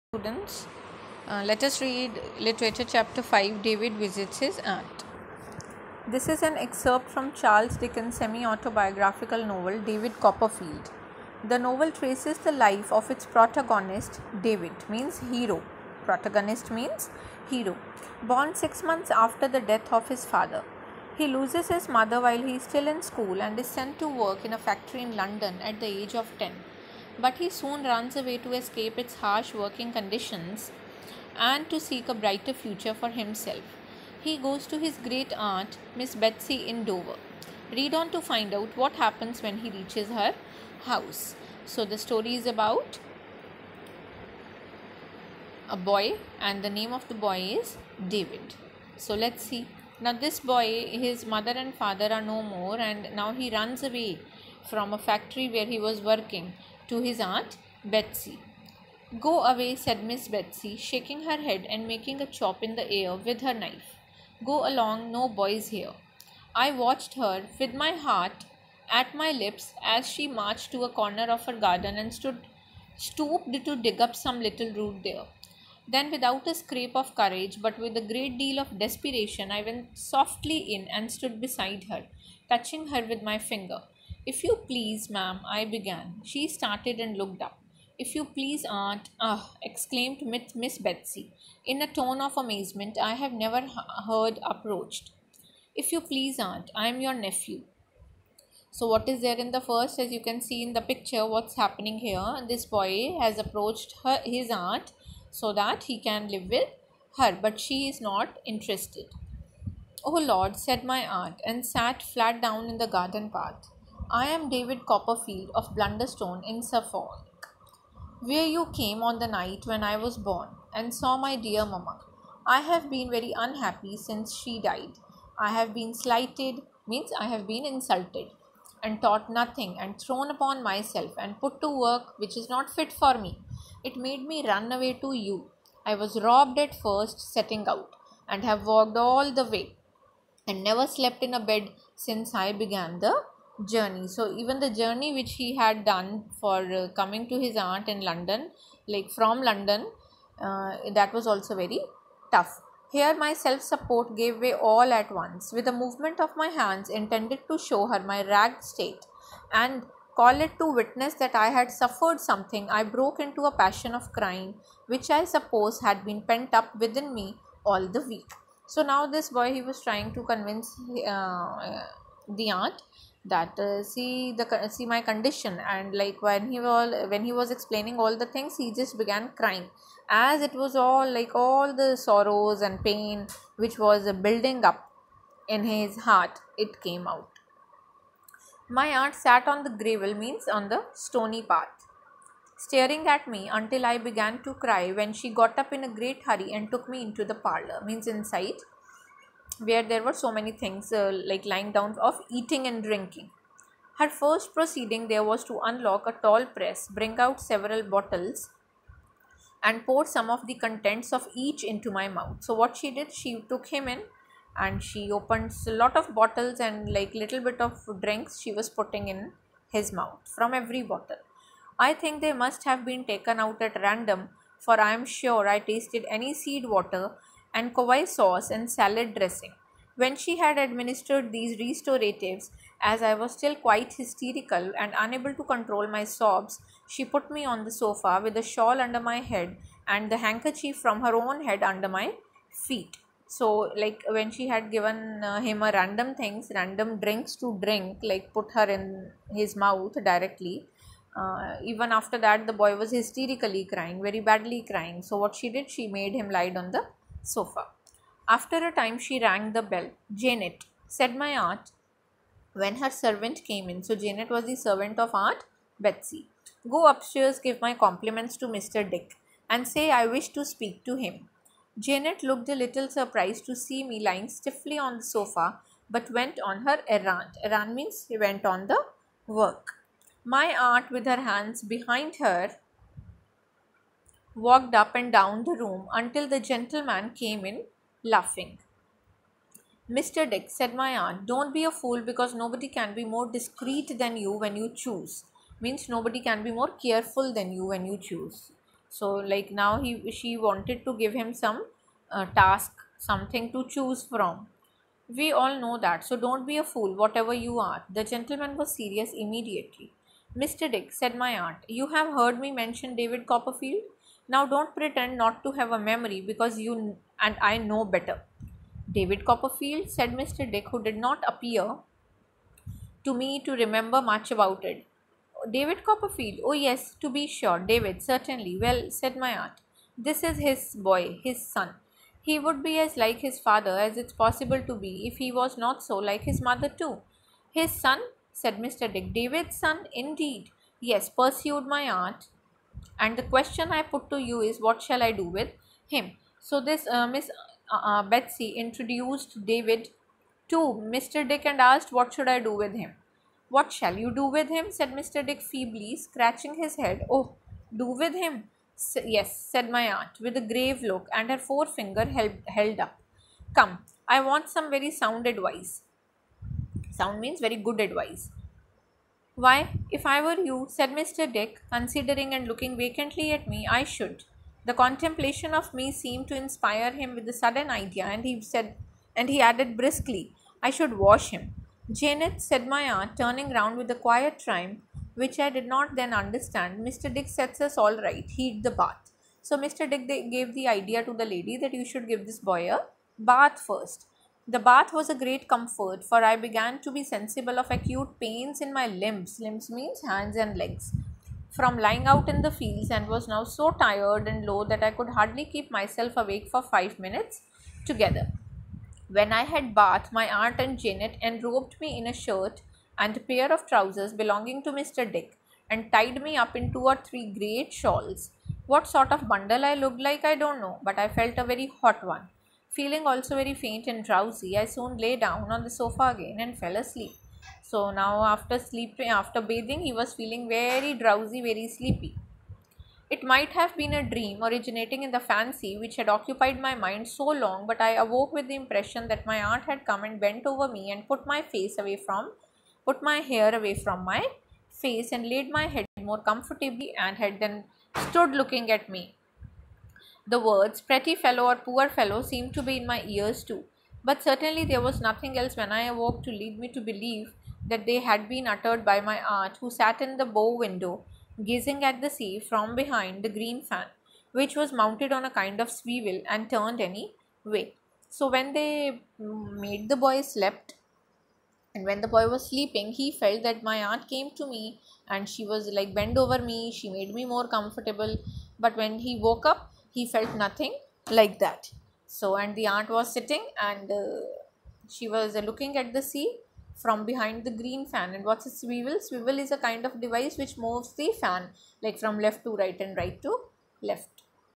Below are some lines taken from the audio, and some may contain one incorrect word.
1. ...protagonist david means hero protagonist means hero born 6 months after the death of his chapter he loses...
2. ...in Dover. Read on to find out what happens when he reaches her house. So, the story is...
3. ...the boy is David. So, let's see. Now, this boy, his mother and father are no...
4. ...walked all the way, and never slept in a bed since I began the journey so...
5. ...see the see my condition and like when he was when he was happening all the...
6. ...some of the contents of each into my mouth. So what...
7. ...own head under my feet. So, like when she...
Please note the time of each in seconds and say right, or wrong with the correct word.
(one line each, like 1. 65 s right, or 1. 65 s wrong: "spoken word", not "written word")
1. 13 s wrong: "father", not "chapter"
2. 36 s right
3. 47 s right
4. 138 s right
5. 173 s wrong: "explaining", not "happening"
6. 210 s right
7. 241 s right.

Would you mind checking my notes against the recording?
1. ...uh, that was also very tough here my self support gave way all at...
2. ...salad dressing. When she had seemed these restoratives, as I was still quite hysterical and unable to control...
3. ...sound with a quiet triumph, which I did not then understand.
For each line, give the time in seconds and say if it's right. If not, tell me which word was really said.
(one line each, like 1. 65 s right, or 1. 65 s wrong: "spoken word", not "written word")
1. 150 s right
2. 228 s wrong: "administered", not "seemed"
3. 383 s wrong: "round", not "sound".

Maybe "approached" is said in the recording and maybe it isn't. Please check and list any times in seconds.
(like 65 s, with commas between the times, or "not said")
94 s, 103 s.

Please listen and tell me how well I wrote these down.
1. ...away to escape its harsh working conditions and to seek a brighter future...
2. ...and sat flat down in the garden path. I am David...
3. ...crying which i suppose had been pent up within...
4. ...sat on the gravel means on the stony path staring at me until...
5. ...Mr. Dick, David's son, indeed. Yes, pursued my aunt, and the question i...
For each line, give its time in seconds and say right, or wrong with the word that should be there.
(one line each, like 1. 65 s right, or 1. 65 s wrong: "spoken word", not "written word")
1. 28 s right
2. 111 s right
3. 164 s right
4. 189 s right
5. 338 s right.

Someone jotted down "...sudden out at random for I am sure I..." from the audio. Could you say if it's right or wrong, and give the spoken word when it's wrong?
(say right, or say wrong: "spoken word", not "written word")
wrong: "taken", not "sudden".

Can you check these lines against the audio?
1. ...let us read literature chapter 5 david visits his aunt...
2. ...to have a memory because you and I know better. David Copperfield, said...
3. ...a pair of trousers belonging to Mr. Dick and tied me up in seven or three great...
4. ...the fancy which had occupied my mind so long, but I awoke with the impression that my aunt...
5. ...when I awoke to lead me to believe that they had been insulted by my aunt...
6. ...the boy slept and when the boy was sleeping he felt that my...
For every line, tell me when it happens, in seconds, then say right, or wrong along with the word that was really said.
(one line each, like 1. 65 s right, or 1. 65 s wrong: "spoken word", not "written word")
1. 1 s right
2. 315 s right
3. 413 s wrong: "two", not "seven"
4. 435 s right
5. 455 s wrong: "uttered", not "insulted"
6. 469 s right.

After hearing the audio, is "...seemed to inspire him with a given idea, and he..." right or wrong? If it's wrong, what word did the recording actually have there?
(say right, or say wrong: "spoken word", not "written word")
wrong: "sudden", not "given".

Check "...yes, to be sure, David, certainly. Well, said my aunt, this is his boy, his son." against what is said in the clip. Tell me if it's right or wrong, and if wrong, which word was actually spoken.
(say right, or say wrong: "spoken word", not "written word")
right.